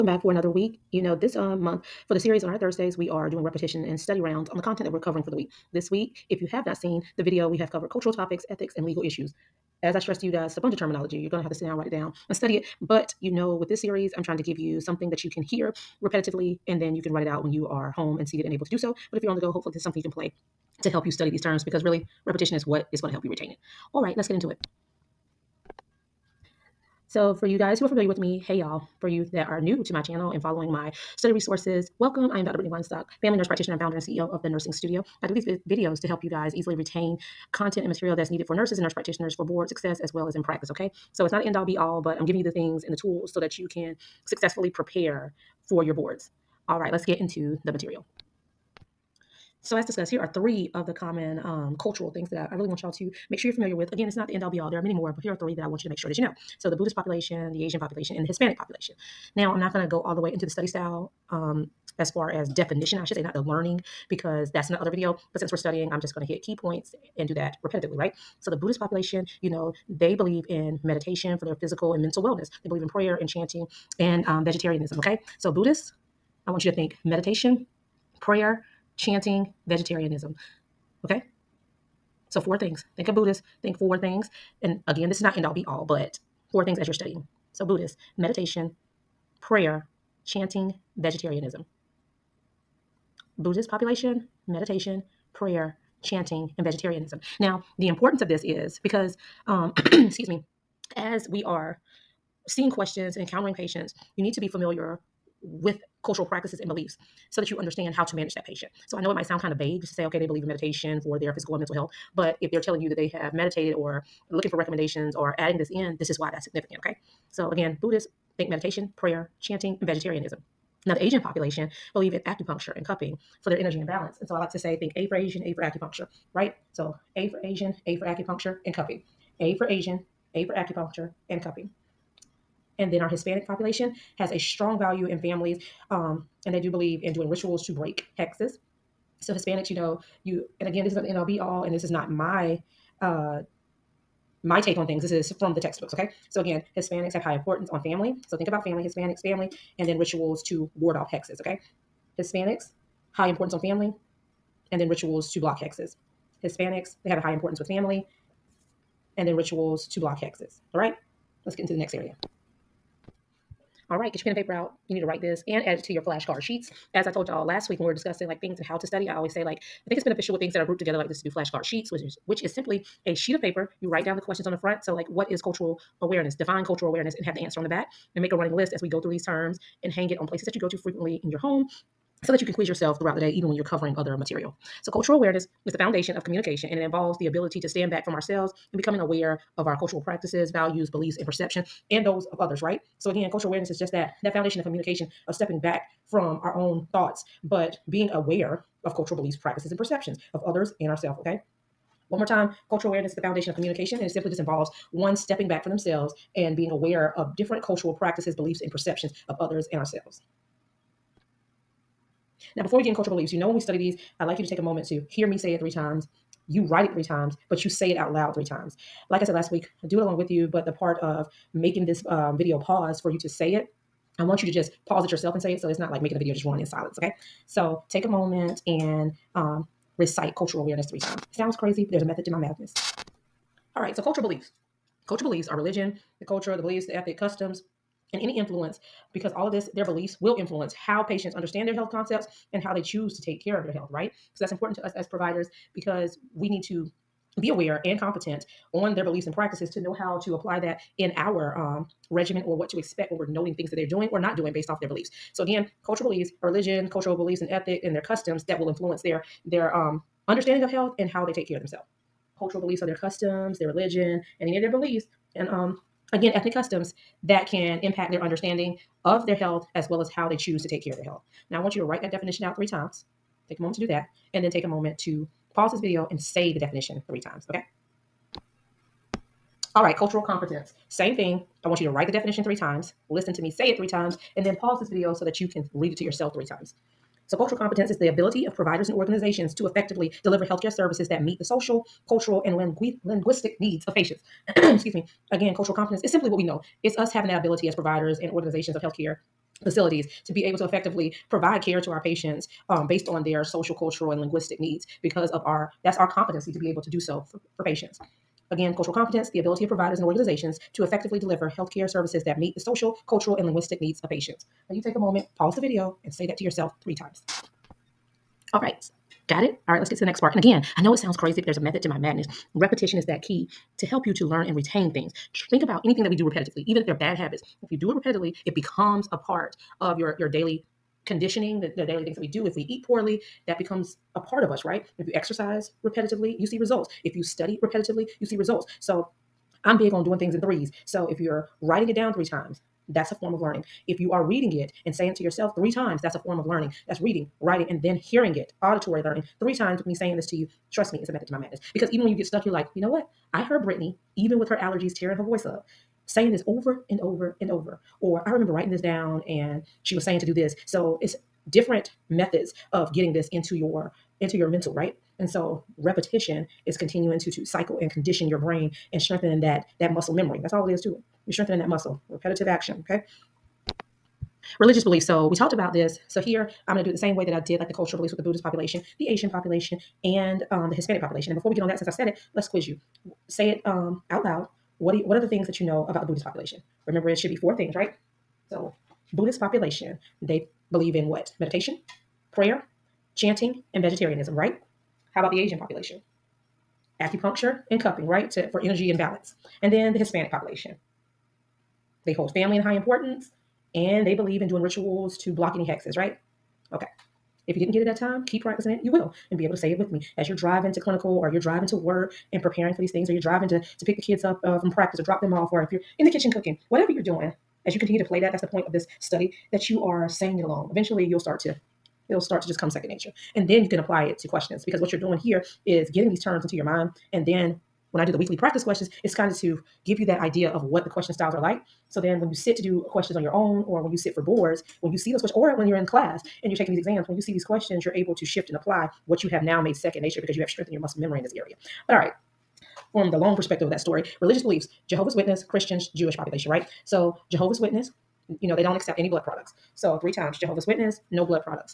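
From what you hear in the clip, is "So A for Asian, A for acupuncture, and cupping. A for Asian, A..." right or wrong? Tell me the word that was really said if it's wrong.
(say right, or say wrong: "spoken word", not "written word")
right.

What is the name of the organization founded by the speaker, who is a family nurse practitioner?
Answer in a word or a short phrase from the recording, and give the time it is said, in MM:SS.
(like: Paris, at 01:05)
The Nursing Studio, at 00:34.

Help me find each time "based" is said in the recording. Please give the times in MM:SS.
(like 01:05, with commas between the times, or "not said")
04:14, 05:02.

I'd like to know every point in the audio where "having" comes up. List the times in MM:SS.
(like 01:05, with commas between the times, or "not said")
04:57.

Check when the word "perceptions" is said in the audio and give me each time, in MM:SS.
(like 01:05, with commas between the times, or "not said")
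03:11, 03:19, 03:28.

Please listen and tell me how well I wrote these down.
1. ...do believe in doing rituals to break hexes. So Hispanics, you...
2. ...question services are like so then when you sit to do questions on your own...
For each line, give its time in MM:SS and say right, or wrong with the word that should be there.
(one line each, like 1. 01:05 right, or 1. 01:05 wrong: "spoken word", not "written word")
1. 02:16 right
2. 07:10 wrong: "styles", not "services".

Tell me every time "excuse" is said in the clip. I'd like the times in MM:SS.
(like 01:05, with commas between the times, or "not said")
01:39, 04:54.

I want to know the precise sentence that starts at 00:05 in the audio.
This week, if you have not seen the video, we have covered cultural topics, ethics, and legal issues.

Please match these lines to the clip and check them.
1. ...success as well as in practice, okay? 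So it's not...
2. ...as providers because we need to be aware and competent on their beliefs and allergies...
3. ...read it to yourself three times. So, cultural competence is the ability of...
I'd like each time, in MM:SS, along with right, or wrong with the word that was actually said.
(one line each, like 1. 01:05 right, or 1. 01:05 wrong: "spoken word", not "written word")
1. 00:39 right
2. 04:04 wrong: "practices", not "allergies"
3. 04:45 right.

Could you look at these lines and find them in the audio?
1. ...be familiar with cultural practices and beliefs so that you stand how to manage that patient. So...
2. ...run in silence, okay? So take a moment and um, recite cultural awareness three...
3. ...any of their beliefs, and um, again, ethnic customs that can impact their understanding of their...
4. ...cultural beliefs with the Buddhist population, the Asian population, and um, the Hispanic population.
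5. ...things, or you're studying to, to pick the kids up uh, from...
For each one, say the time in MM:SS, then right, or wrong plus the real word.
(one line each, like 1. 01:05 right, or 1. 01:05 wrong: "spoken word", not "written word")
1. 01:44 wrong: "understand", not "stand"
2. 03:46 right
3. 04:24 right
4. 06:17 right
5. 06:52 wrong: "driving", not "studying".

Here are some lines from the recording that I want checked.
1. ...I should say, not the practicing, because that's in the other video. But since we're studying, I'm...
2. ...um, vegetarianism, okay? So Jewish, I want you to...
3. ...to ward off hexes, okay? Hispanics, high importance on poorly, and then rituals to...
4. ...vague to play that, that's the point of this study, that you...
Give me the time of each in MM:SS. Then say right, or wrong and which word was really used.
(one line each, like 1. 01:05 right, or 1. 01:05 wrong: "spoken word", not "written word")
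1. 01:02 wrong: "learning", not "practicing"
2. 01:14 wrong: "Buddhists", not "Jewish"
3. 02:30 wrong: "family", not "poorly"
4. 06:57 wrong: "continue", not "vague".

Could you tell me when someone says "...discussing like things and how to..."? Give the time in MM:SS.
02:47.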